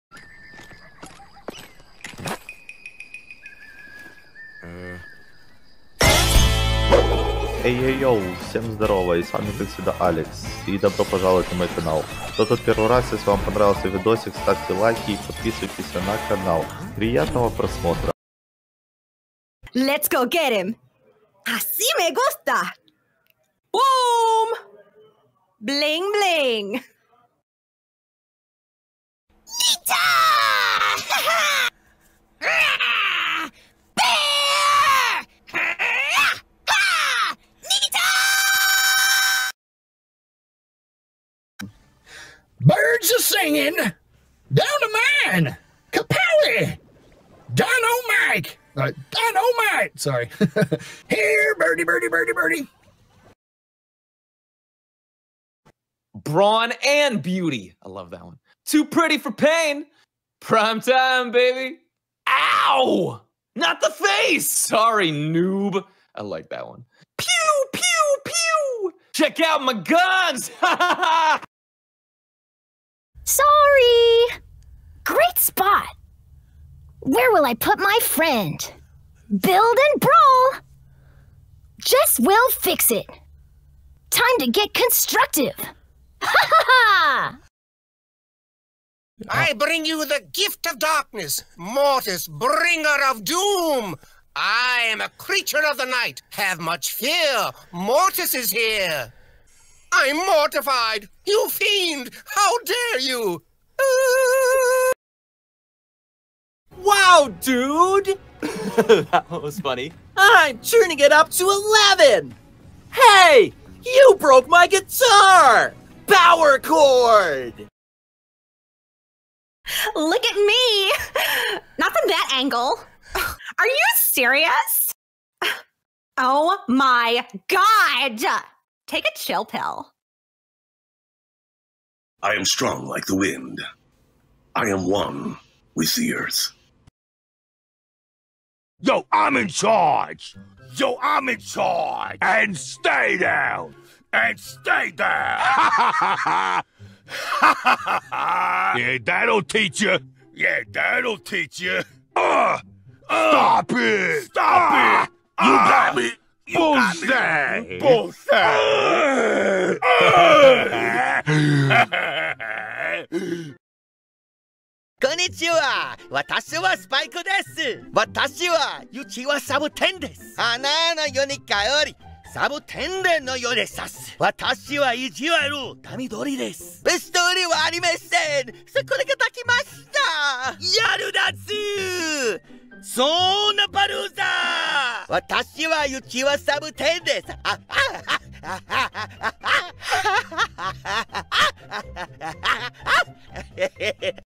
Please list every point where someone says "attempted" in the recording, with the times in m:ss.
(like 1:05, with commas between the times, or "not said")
not said.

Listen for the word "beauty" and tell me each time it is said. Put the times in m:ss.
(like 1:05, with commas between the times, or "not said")
0:57.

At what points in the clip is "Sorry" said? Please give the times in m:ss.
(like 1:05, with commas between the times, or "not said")
0:49, 1:04, 1:13.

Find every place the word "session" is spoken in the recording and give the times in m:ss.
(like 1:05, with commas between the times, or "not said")
not said.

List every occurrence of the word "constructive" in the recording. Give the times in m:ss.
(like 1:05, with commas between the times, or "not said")
1:24.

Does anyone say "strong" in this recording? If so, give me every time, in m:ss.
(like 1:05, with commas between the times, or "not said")
2:12.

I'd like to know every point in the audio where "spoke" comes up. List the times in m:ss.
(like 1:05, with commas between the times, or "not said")
not said.